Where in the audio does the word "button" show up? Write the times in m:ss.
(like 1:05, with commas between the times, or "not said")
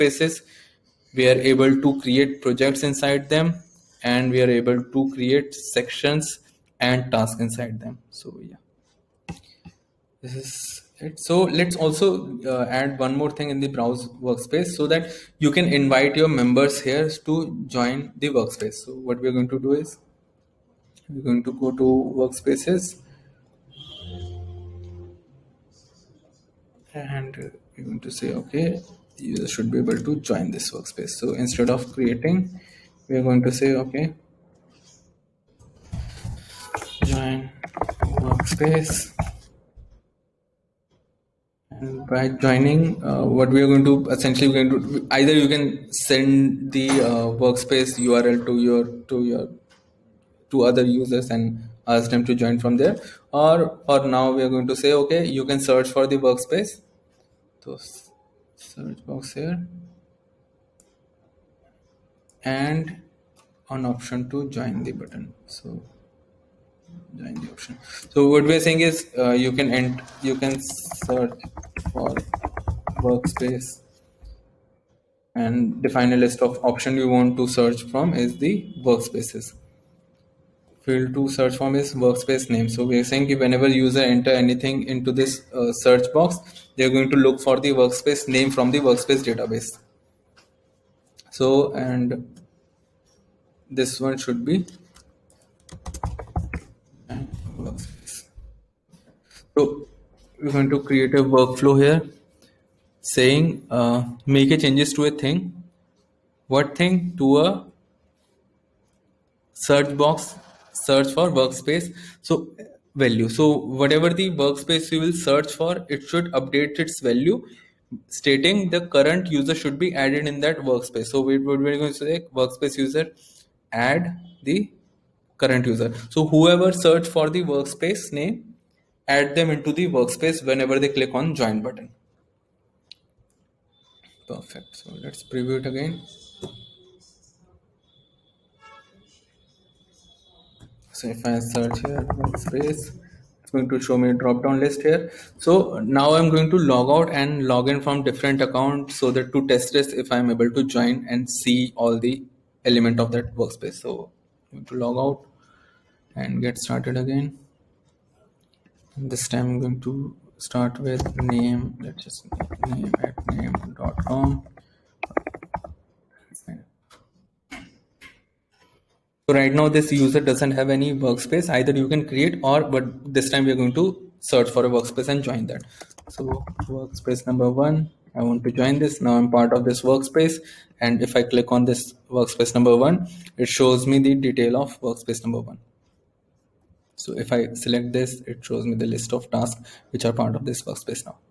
1:05, 2:11.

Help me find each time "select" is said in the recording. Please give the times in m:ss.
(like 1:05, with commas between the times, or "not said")
3:07.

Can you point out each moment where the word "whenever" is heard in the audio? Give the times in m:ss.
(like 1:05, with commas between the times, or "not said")
1:23, 2:10.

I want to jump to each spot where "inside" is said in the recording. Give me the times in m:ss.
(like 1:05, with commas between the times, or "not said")
0:02, 0:07.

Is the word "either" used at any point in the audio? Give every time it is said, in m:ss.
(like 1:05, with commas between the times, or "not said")
0:45, 2:51.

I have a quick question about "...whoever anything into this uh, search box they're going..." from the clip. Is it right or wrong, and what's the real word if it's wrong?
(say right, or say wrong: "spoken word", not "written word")
wrong: "enter", not "whoever".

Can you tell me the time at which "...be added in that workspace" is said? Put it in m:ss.
1:59.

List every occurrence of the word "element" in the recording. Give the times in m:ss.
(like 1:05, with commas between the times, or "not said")
2:32.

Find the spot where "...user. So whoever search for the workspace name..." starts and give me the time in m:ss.
2:05.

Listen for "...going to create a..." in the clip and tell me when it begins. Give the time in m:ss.
1:40.